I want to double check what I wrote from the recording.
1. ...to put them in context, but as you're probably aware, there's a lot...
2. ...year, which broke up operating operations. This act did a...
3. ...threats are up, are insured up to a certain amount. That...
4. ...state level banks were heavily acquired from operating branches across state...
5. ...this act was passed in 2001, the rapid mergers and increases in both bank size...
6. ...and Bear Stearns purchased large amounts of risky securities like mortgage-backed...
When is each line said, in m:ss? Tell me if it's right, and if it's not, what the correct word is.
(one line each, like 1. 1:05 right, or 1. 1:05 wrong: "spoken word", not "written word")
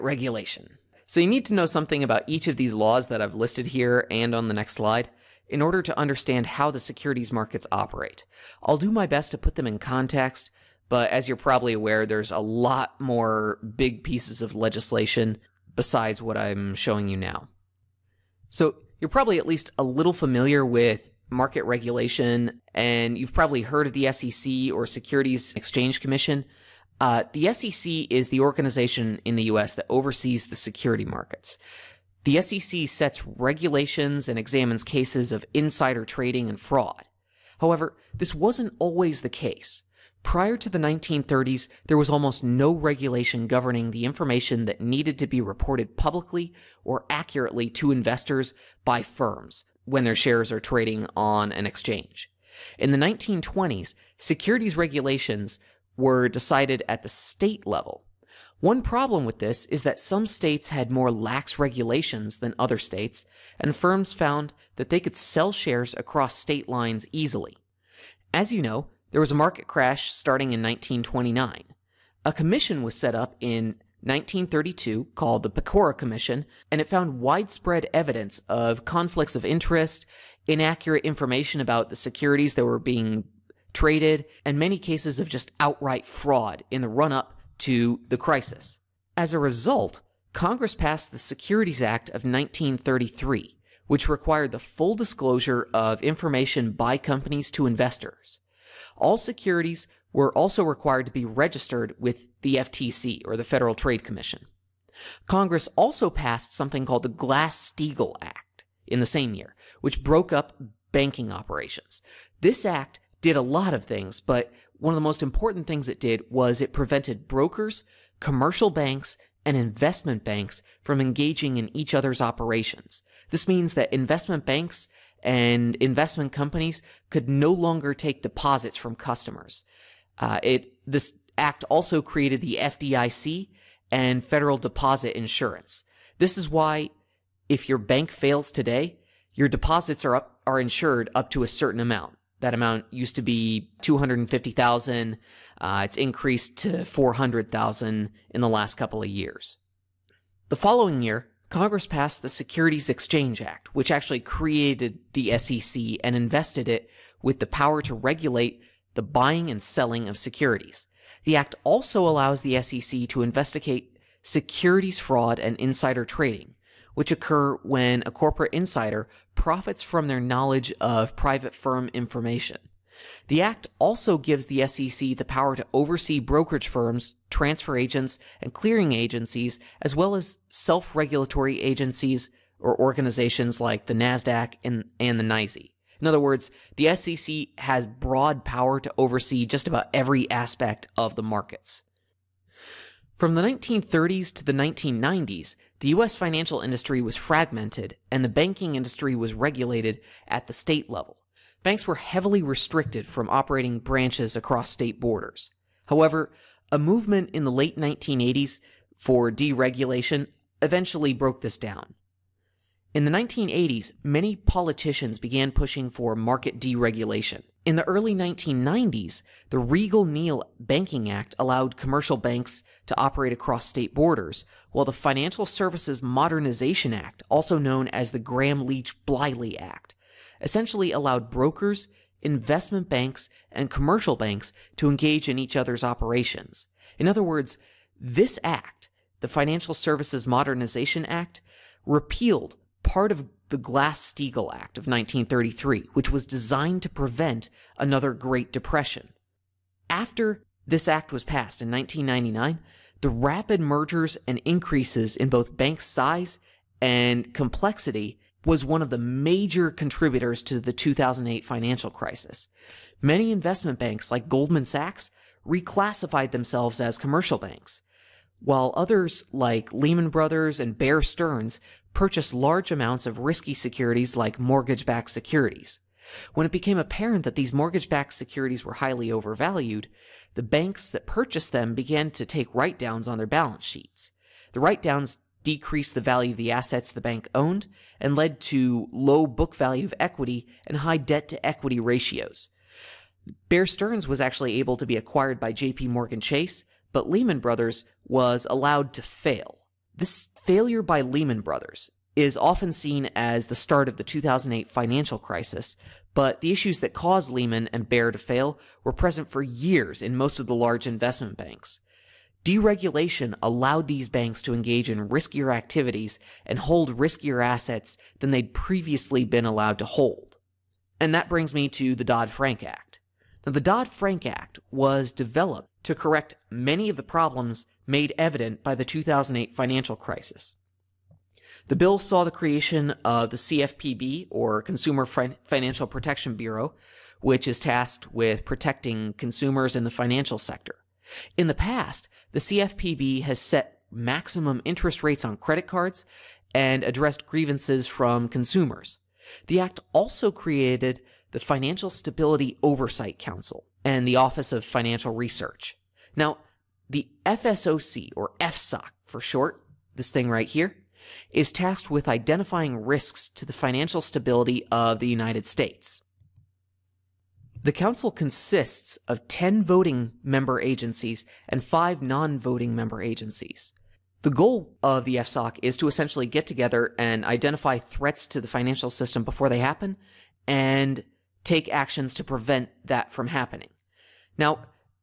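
1. 0:09 right
2. 1:49 wrong: "banking", not "operating"
3. 2:19 wrong: "deposits", not "threats"
4. 3:20 wrong: "restricted", not "acquired"
5. 4:10 wrong: "1999", not "2001"
6. 4:30 right.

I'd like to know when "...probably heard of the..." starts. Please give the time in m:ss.
0:23.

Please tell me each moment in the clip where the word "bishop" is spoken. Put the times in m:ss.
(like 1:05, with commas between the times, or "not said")
not said.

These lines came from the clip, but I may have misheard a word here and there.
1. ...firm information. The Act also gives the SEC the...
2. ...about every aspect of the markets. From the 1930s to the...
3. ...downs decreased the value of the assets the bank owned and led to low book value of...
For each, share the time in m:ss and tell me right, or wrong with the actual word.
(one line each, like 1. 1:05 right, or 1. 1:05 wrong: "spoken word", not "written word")
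1. 2:51 right
2. 3:09 right
3. 4:44 right.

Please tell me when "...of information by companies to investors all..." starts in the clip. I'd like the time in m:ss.
1:35.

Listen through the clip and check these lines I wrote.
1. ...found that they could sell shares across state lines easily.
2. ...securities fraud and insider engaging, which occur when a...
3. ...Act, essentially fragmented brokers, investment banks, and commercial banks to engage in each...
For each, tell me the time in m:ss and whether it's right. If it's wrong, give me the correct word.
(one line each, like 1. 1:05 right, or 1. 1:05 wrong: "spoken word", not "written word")
1. 1:04 right
2. 2:44 wrong: "trading", not "engaging"
3. 3:49 wrong: "allowed", not "fragmented".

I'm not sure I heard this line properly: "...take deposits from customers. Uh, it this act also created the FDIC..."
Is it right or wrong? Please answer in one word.
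right.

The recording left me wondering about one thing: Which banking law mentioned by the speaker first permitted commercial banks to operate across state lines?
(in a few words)
Riegle-Neal Banking Act.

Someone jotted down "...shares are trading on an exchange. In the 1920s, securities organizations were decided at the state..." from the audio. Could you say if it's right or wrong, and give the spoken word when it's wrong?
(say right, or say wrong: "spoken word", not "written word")
wrong: "regulations", not "organizations".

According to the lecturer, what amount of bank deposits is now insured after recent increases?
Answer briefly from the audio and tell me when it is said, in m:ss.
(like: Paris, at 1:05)
400,000, at 2:26.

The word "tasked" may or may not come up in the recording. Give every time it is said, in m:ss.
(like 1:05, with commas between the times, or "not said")
5:37, 6:01.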